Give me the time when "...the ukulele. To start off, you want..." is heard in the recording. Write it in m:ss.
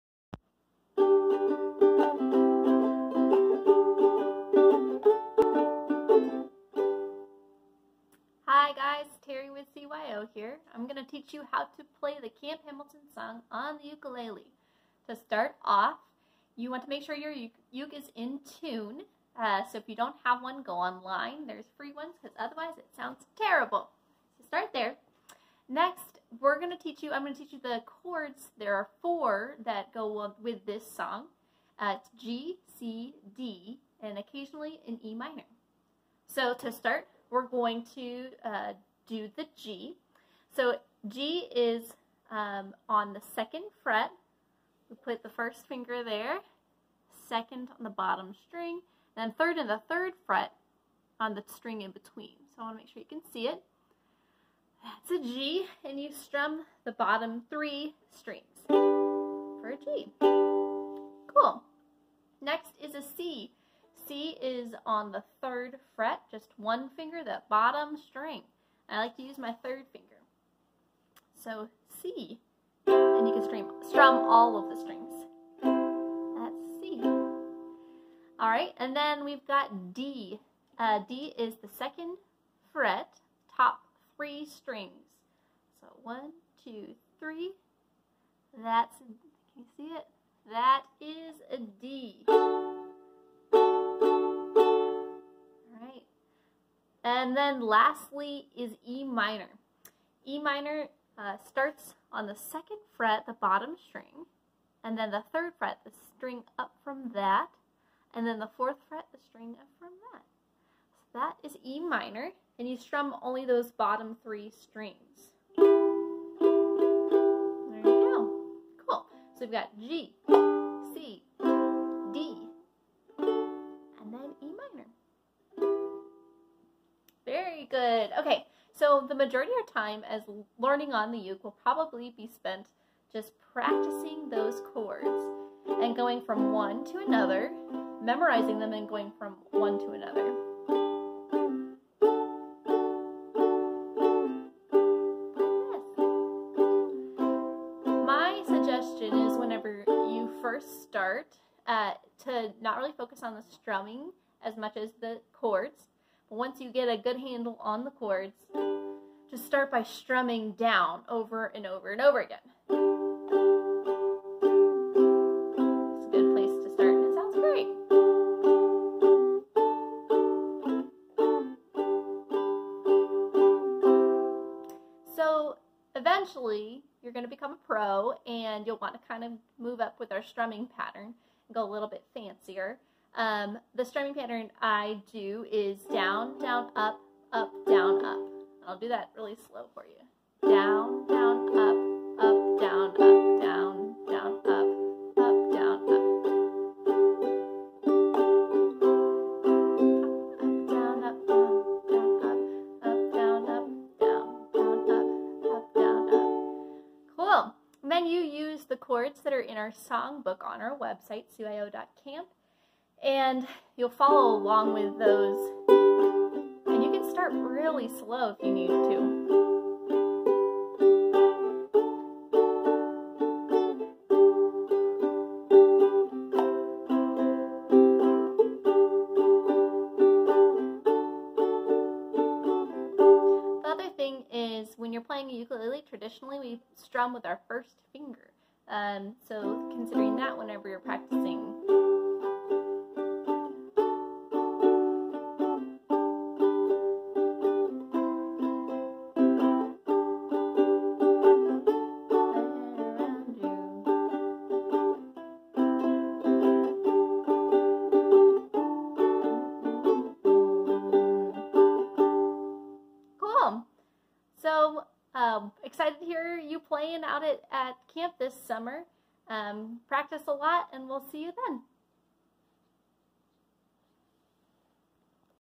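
0:13.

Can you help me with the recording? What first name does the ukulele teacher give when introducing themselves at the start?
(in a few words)
Terry.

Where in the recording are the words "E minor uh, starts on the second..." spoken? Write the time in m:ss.
1:40.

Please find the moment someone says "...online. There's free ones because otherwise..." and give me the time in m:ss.
0:20.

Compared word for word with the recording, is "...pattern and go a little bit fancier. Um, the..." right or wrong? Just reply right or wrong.
right.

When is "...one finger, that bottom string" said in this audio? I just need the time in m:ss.
1:06.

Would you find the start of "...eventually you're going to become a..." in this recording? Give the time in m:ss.
2:55.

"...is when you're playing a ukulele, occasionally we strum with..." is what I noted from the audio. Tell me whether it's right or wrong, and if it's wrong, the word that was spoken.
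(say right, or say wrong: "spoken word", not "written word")
wrong: "traditionally", not "occasionally".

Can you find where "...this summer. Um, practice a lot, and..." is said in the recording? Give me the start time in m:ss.
4:28.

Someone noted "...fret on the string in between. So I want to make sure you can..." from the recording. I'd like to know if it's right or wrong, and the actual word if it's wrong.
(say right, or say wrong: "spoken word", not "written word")
right.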